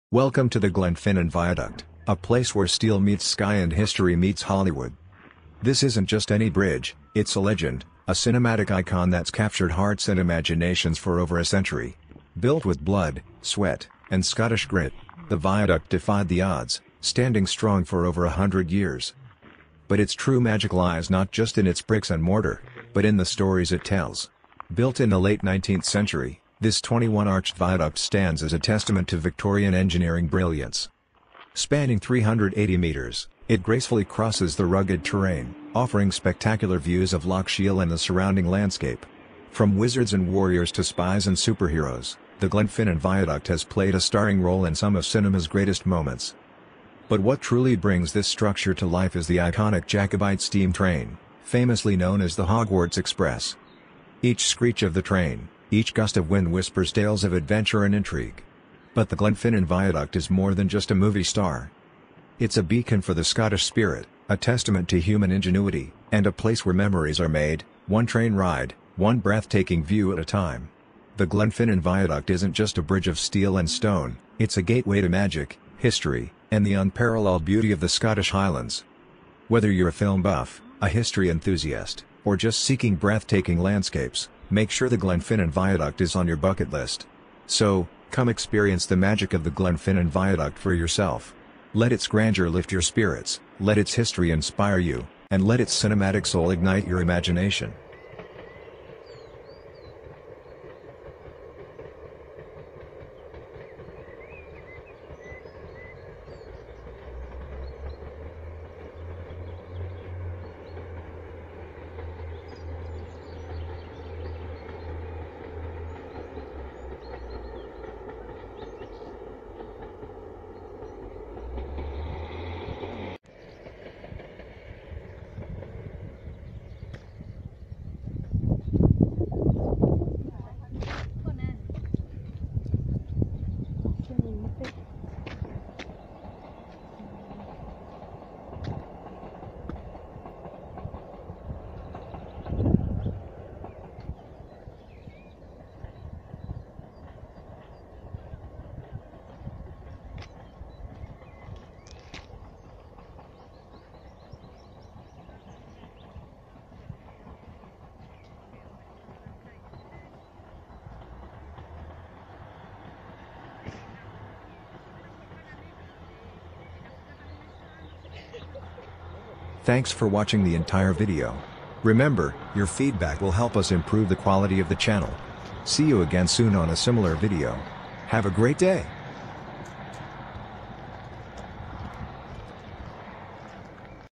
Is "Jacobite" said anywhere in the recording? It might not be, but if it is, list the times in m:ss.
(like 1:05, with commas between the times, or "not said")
0:49.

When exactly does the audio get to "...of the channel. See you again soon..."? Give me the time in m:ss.
2:54.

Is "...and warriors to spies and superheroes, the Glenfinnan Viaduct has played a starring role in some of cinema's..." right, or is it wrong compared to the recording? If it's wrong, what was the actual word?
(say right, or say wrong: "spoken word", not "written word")
right.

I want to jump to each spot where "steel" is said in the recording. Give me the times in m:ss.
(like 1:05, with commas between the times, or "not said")
0:02, 1:13.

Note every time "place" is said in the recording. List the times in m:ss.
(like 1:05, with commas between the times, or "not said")
0:02, 1:06.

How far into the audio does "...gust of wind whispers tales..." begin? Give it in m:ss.
0:55.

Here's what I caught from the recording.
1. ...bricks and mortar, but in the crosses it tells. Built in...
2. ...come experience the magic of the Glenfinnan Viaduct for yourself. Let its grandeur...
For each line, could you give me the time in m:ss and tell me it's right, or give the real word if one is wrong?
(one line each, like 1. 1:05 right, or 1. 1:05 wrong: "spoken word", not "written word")
1. 0:21 wrong: "stories", not "crosses"
2. 1:28 right.